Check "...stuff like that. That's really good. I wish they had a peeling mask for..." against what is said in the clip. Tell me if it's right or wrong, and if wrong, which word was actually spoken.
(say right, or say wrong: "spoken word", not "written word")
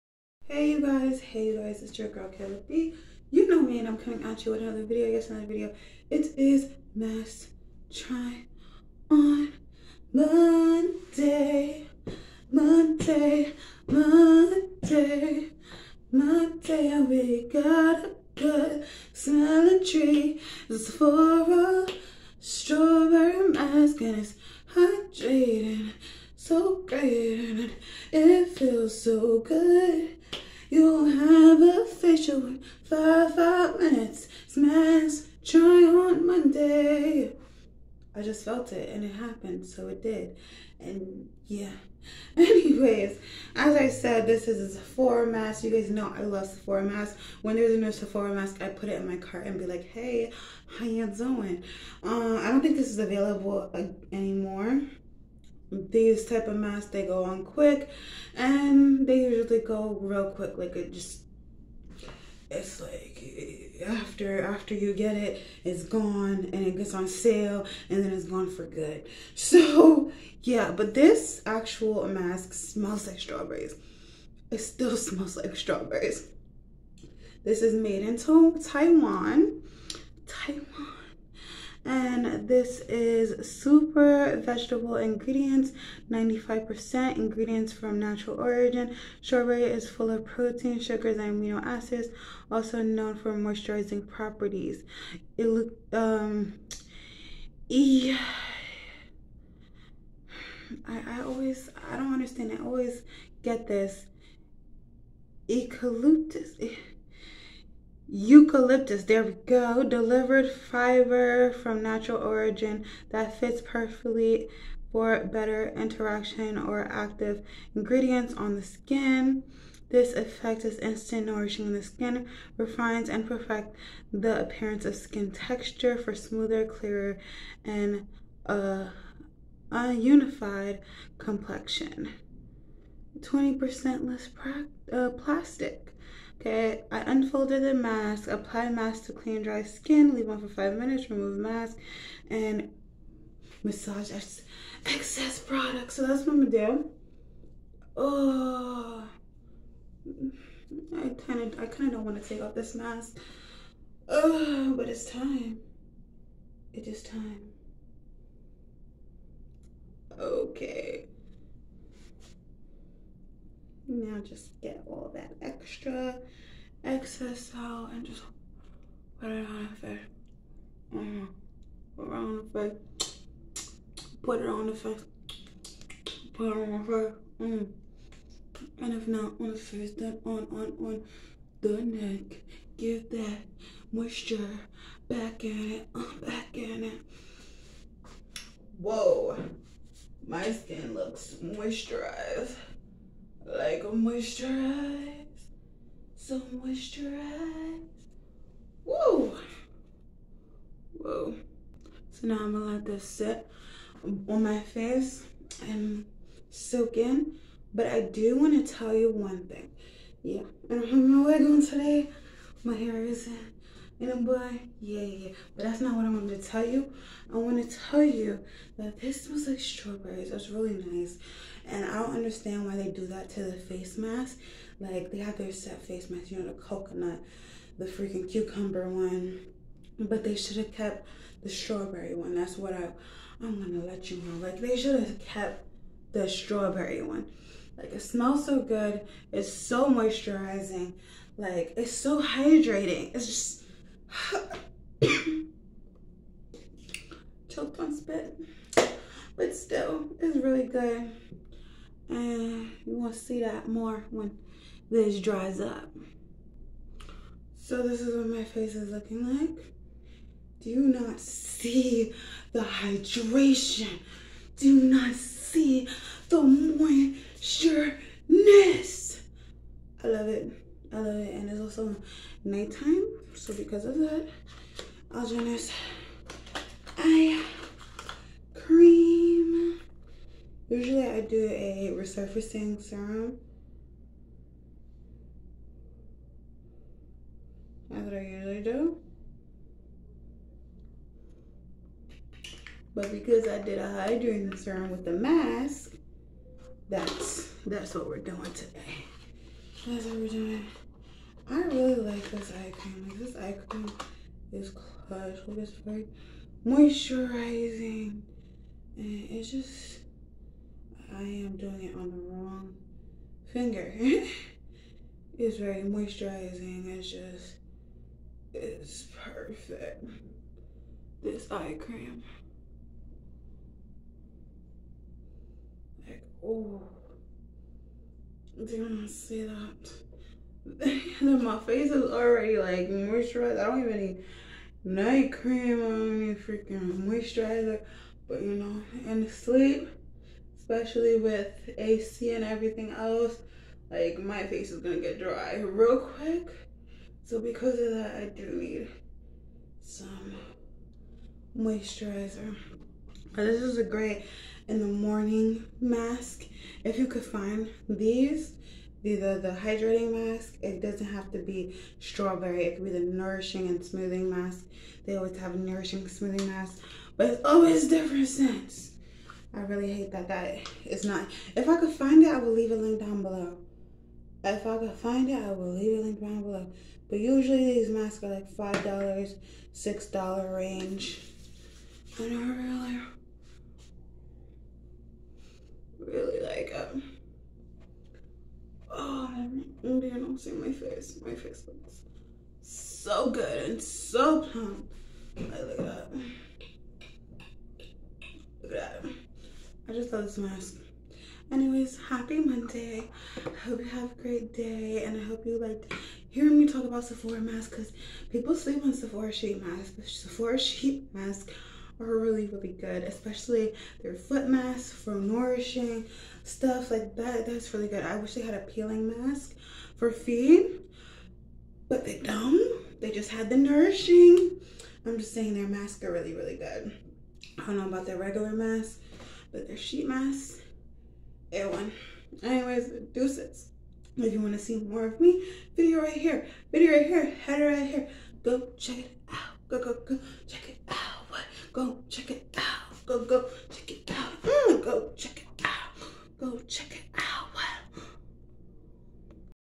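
right.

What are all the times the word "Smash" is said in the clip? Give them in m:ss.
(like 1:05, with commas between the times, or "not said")
0:34.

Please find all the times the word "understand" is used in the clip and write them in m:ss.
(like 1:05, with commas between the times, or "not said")
1:42, 3:42.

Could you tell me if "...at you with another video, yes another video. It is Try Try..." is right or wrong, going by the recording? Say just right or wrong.
wrong.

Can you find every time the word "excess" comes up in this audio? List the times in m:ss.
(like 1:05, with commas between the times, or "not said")
2:24, 2:46.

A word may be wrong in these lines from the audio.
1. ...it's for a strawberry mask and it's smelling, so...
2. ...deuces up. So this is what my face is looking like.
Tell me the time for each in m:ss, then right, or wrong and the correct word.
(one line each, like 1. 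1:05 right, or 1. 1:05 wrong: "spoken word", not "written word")
1. 0:20 wrong: "hydrating", not "smelling"
2. 4:15 wrong: "dries", not "deuces".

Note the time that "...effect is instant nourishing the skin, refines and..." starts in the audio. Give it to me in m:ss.
2:00.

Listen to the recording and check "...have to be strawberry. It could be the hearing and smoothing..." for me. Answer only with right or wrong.
wrong.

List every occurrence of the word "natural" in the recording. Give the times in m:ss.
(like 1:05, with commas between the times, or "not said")
1:27, 1:51.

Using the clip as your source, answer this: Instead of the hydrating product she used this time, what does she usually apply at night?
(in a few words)
resurfacing serum.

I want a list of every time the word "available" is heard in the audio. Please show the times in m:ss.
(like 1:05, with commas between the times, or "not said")
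0:52.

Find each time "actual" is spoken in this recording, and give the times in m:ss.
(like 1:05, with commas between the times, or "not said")
1:11.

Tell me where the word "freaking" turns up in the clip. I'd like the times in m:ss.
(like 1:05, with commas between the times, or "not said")
3:47, 5:36.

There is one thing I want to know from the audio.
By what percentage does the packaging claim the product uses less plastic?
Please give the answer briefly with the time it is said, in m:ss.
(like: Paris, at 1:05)
20%, at 2:13.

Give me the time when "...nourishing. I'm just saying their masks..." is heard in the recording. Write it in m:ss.
7:03.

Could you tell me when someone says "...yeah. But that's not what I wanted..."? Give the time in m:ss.
3:35.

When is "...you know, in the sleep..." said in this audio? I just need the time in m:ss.
5:38.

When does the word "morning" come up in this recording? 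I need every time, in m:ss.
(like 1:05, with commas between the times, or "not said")
5:54.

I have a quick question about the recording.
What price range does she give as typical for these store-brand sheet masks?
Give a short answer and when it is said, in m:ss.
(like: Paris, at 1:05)
5 to 6 dollars, at 6:18.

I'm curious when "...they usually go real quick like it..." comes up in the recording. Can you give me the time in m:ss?
0:59.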